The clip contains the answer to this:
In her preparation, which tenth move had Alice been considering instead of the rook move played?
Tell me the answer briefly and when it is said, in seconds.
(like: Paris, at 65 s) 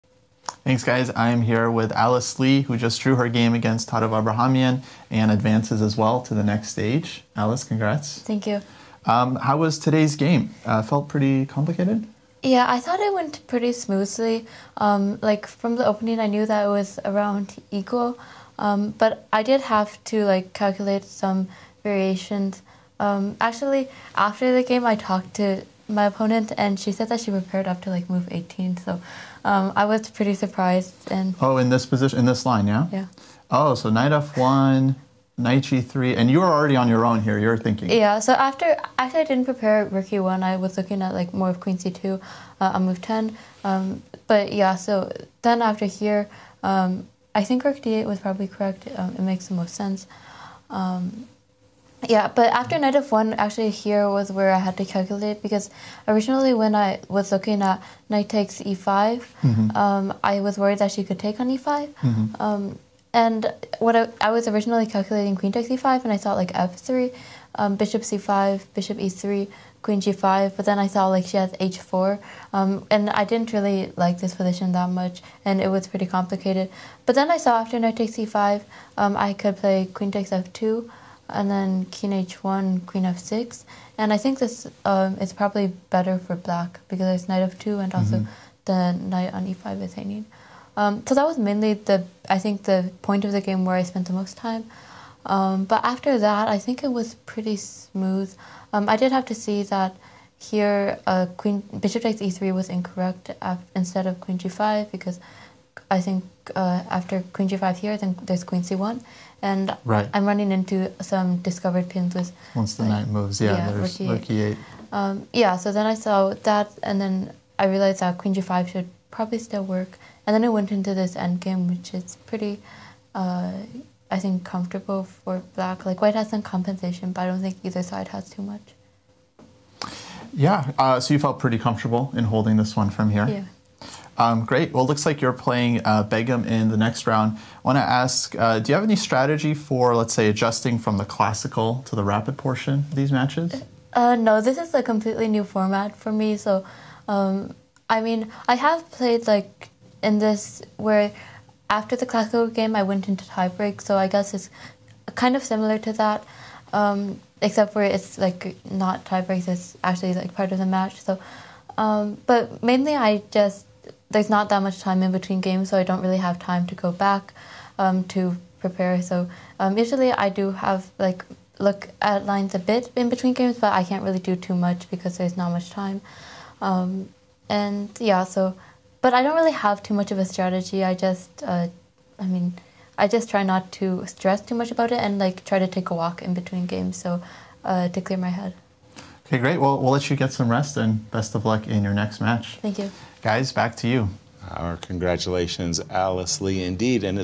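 Queen c2, at 41 s.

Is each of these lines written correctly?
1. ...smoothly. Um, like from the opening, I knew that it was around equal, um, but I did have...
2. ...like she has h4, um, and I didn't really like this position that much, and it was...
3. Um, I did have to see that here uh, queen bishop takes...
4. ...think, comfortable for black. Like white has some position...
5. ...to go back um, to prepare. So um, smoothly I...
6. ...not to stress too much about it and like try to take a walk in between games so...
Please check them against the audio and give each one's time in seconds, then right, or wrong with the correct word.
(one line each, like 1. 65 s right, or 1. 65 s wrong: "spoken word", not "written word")
1. 13 s right
2. 71 s right
3. 98 s right
4. 124 s wrong: "compensation", not "position"
5. 166 s wrong: "usually", not "smoothly"
6. 183 s right.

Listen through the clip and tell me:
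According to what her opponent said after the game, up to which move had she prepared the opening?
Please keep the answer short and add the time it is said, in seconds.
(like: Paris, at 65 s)
18, at 28 s.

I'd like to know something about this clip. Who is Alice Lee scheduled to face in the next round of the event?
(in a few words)
Begim.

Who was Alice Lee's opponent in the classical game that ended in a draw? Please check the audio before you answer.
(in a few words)
Tatev Abrahamyan.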